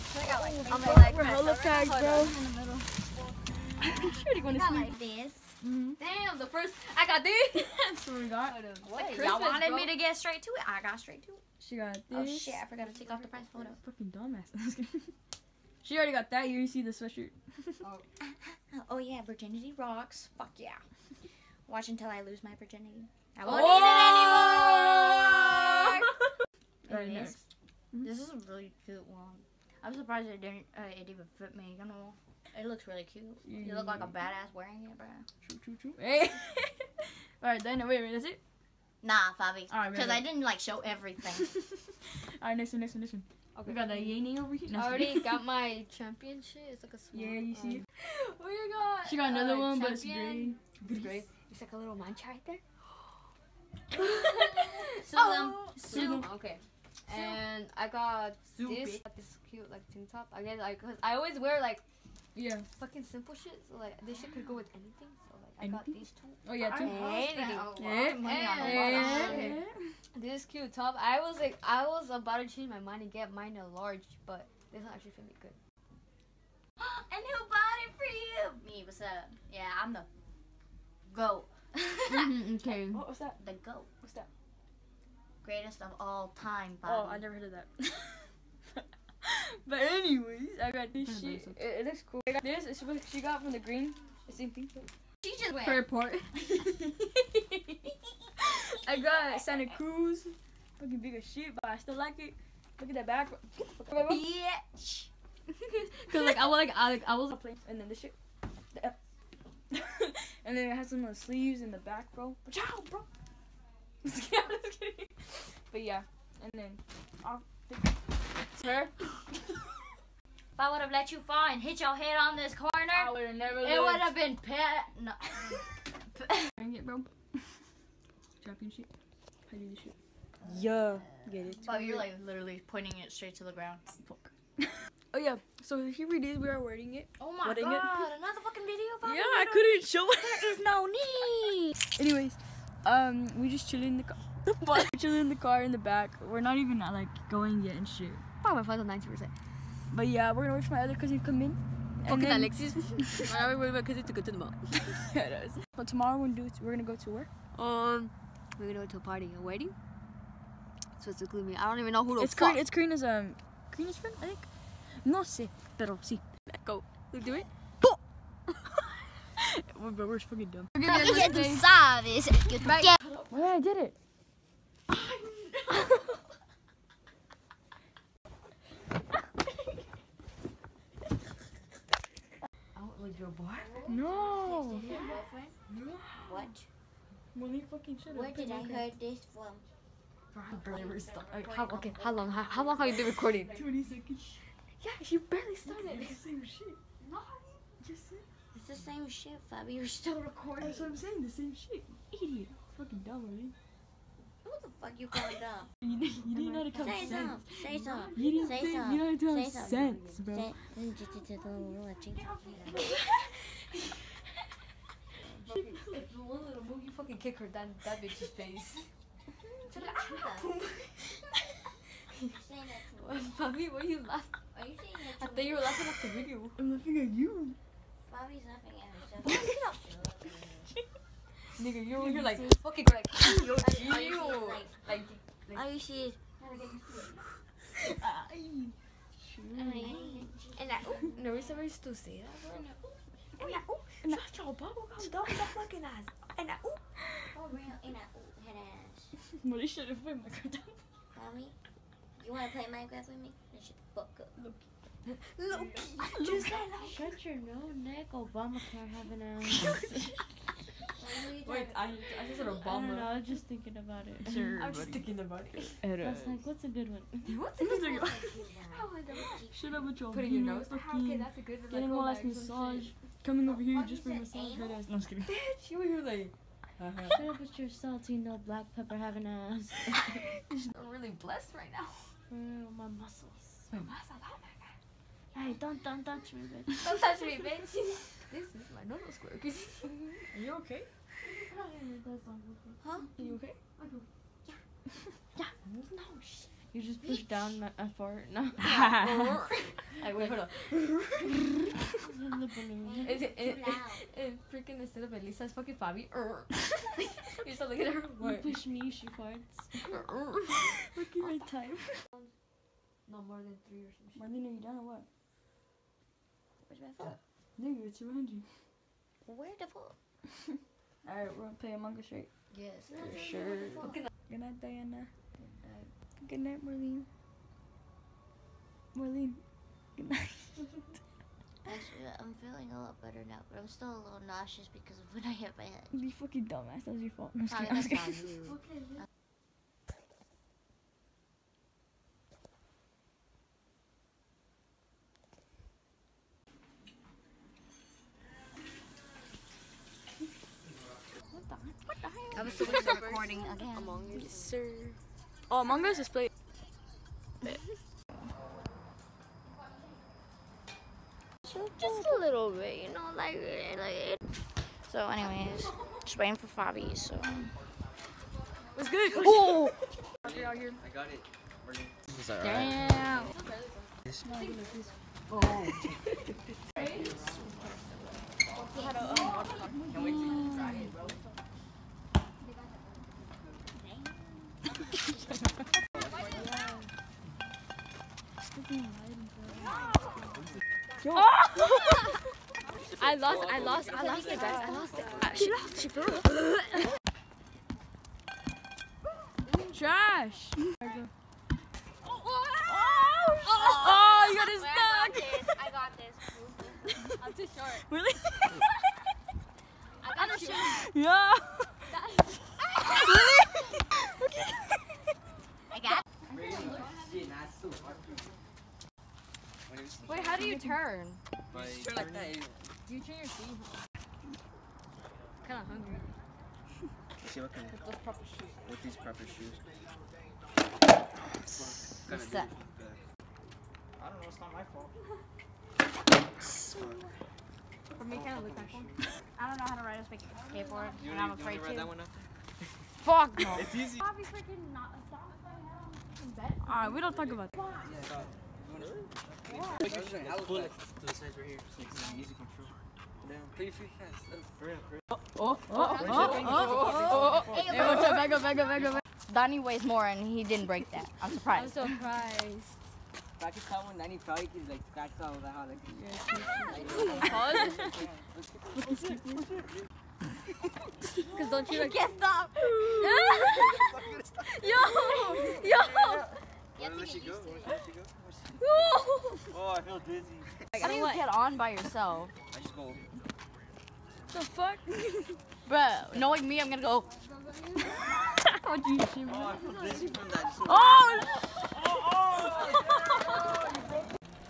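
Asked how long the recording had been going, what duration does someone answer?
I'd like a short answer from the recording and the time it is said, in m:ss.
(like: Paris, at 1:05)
20 seconds, at 3:13.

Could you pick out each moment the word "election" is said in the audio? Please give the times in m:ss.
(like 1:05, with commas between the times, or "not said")
not said.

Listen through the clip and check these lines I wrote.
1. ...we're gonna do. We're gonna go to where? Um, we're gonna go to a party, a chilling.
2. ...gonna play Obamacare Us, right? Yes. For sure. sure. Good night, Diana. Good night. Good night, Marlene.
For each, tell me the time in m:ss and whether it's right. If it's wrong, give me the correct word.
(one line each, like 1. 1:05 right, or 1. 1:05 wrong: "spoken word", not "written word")
1. 2:36 wrong: "wedding", not "chilling"
2. 5:21 wrong: "Among", not "Obamacare".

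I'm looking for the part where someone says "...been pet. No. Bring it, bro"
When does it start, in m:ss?
2:04.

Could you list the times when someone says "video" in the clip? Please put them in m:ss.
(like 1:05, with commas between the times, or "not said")
2:18, 3:46.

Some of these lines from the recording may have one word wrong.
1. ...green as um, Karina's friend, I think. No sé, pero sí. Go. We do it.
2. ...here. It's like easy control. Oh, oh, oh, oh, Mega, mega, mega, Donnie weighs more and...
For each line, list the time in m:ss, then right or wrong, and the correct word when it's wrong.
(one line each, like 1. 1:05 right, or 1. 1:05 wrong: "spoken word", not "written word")
1. 2:42 right
2. 7:31 right.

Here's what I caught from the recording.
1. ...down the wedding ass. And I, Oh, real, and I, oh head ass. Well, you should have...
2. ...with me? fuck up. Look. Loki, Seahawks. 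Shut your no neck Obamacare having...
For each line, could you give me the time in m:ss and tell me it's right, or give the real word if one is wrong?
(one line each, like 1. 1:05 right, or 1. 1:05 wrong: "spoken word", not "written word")
1. 4:05 wrong: "fucking", not "wedding"
2. 4:13 wrong: "Gisella", not "Seahawks".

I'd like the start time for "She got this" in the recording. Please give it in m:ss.
0:11.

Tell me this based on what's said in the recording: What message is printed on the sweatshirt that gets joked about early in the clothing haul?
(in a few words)
Virginity rocks.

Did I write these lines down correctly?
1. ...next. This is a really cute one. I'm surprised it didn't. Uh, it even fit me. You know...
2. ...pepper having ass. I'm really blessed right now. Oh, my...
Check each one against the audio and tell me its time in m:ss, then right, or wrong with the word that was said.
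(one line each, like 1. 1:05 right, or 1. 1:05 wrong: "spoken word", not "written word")
1. 0:27 right
2. 4:38 right.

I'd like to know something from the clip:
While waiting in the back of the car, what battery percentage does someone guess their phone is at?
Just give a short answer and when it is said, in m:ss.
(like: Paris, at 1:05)
90 percent, at 2:28.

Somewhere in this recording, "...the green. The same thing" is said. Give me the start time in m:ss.
1:33.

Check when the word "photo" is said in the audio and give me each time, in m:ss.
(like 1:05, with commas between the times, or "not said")
0:13.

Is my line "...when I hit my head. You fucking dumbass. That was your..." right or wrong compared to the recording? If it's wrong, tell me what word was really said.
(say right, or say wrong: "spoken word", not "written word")
right.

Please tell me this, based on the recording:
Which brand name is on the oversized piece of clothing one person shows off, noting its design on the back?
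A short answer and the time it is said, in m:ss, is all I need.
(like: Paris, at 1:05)
Santa Cruz, at 1:39.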